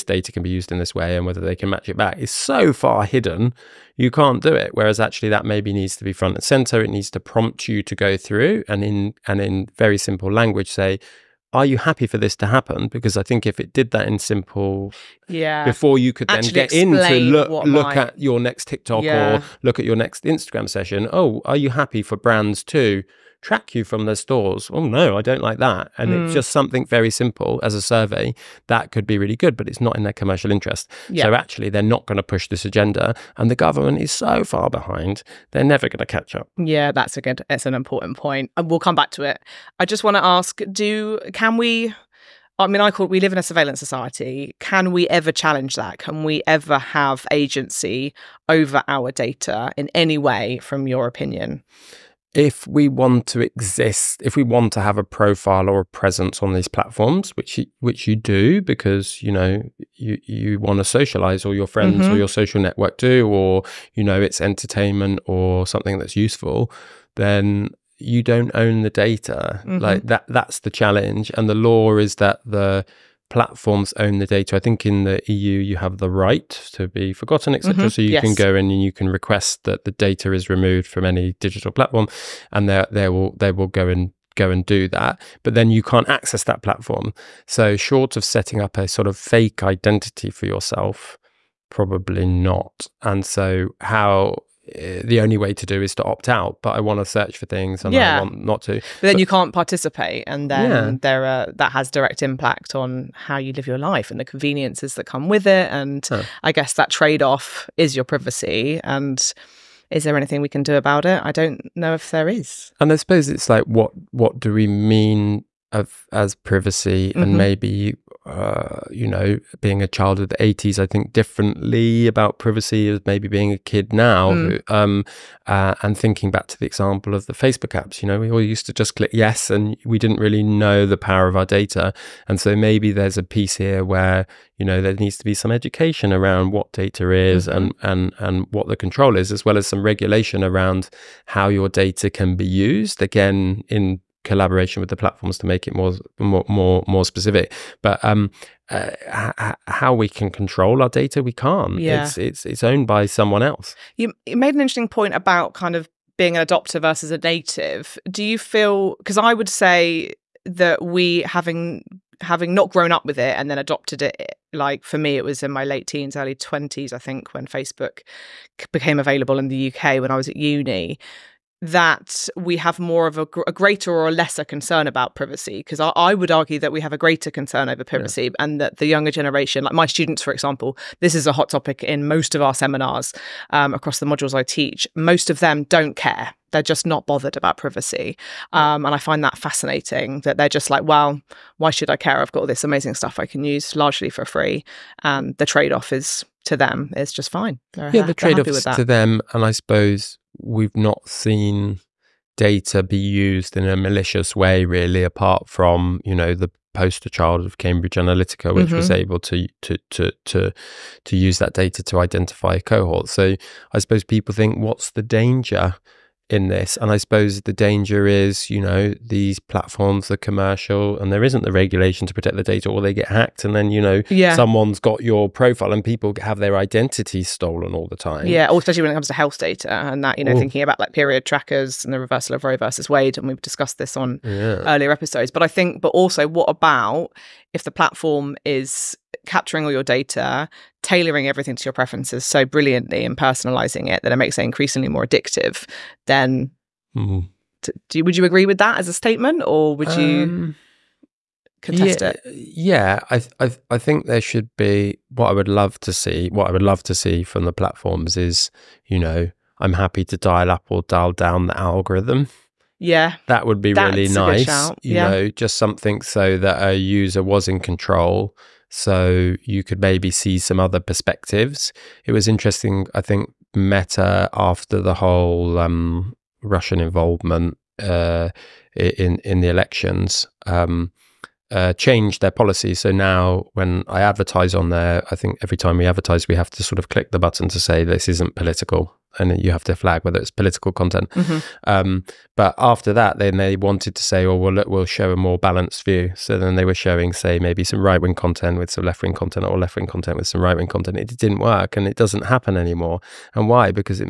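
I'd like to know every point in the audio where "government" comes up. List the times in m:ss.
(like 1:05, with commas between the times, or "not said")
0:33.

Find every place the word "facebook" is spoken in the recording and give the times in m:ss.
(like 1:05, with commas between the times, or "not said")
2:07, 2:47.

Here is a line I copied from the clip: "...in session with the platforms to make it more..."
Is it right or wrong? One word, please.
wrong.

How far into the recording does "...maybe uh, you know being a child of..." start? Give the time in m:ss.
1:57.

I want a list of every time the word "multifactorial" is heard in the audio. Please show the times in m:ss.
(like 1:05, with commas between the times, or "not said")
not said.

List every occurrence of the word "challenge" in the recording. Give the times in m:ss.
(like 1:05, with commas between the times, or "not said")
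0:45, 1:10.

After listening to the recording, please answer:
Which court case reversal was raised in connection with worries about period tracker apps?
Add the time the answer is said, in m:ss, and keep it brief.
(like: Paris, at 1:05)
Roe versus Wade, at 3:52.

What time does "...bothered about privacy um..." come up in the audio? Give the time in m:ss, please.
3:07.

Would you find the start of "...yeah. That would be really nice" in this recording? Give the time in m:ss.
4:22.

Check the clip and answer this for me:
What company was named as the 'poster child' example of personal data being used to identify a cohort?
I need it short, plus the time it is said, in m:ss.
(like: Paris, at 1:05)
Cambridge Analytica, at 3:27.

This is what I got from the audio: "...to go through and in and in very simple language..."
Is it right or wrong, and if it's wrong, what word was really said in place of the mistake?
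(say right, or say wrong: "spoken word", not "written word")
right.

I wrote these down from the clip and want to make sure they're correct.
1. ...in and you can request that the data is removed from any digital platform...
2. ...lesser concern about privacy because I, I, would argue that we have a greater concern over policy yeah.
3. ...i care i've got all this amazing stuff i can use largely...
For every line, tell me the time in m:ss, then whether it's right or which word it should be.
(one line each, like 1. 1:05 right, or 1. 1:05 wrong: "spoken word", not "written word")
1. 1:18 right
2. 2:54 wrong: "privacy", not "policy"
3. 3:11 right.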